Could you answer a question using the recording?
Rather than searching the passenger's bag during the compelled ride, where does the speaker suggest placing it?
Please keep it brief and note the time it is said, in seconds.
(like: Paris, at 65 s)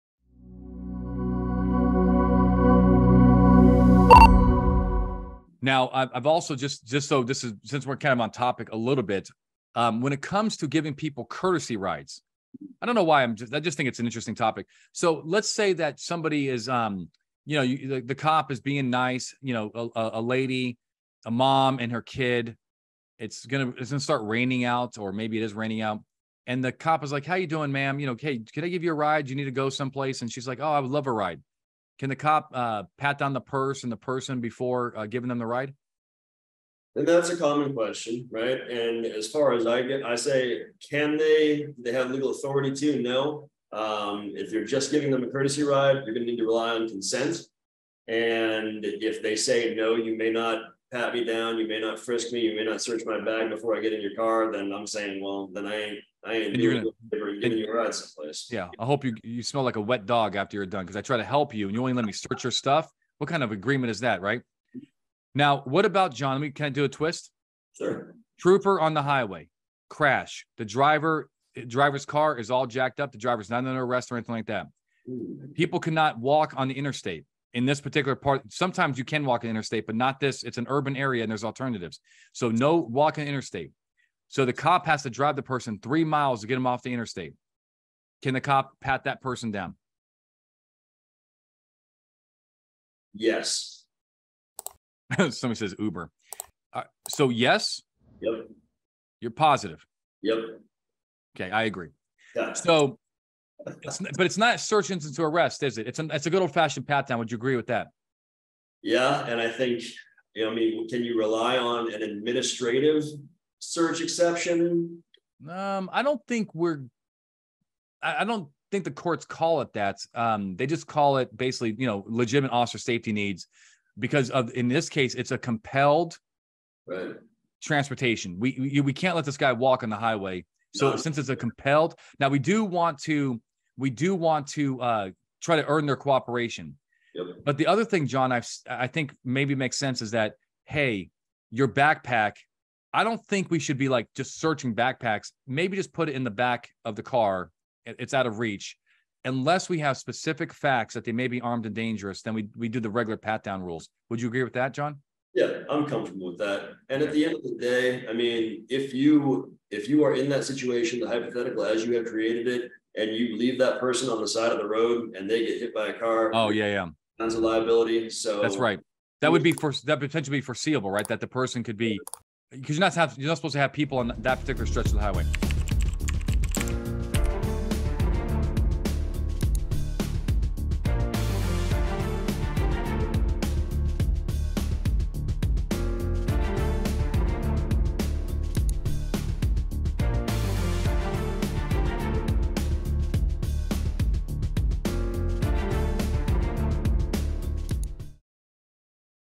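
The back of the car, at 146 s.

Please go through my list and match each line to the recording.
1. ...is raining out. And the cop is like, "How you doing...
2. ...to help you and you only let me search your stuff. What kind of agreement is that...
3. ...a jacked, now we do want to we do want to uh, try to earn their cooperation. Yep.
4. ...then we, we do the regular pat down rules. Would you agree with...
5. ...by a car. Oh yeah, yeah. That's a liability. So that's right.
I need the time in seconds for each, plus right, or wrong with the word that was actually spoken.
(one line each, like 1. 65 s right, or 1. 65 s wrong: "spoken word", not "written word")
1. 25 s right
2. 61 s right
3. 131 s wrong: "compelled", not "jacked"
4. 152 s right
5. 165 s right.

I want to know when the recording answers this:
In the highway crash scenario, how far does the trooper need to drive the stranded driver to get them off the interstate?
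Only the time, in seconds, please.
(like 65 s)
85 s.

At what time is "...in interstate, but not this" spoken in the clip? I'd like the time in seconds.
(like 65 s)
79 s.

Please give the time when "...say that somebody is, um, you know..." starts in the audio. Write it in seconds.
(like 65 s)
15 s.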